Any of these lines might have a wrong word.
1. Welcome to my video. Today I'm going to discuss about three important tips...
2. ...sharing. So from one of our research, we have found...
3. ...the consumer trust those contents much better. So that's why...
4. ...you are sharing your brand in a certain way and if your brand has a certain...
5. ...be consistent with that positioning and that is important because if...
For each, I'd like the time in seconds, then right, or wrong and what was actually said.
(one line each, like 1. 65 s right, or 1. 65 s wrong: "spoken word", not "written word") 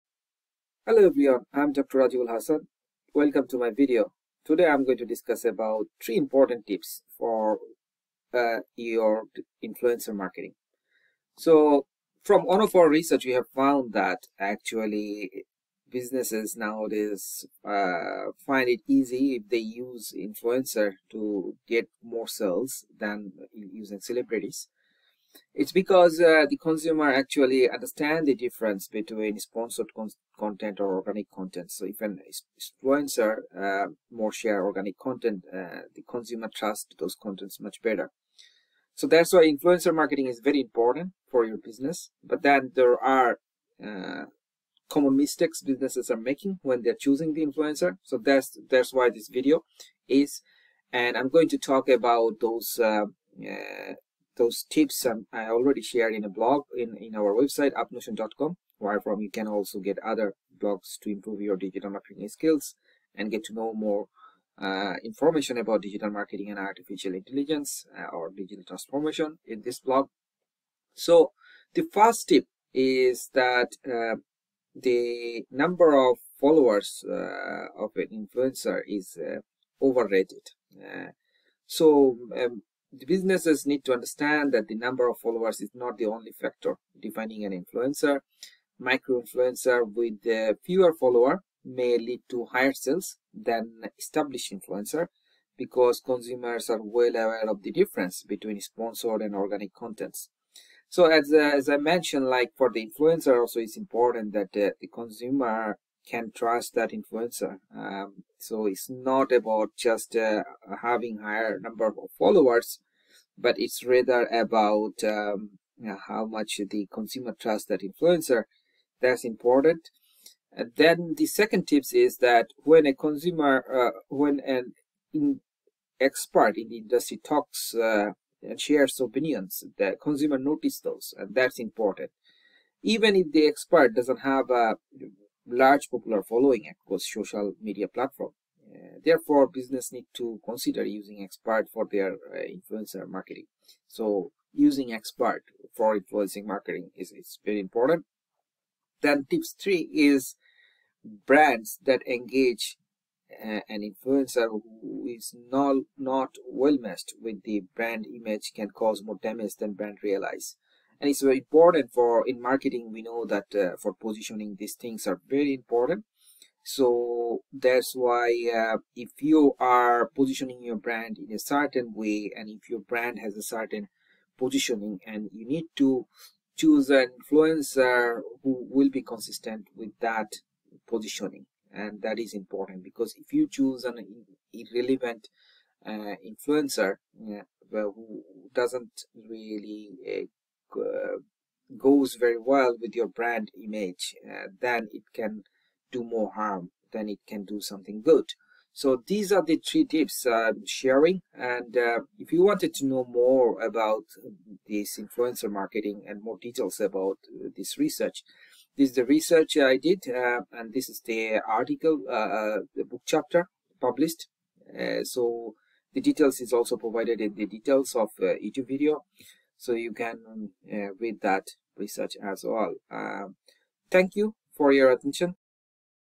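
1. 3 s right
2. 10 s wrong: "marketing", not "sharing"
3. 35 s right
4. 169 s wrong: "positioning", not "sharing"
5. 178 s right.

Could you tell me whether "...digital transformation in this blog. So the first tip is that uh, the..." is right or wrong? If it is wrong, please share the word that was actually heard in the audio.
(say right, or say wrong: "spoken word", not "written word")
right.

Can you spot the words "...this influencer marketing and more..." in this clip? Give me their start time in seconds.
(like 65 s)
204 s.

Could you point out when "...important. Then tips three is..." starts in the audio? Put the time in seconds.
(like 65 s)
147 s.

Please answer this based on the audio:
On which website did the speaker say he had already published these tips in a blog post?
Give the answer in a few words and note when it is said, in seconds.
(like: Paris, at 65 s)
upmotion.com, at 57 s.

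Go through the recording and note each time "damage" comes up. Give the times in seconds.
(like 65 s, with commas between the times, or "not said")
159 s.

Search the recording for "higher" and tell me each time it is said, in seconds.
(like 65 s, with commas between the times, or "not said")
92 s, 111 s.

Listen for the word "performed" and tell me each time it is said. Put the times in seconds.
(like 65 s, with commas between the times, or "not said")
not said.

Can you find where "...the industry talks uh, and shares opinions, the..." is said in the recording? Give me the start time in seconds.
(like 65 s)
126 s.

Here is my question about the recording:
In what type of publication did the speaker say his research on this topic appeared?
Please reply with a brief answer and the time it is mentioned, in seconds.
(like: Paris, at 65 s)
book chapter, at 212 s.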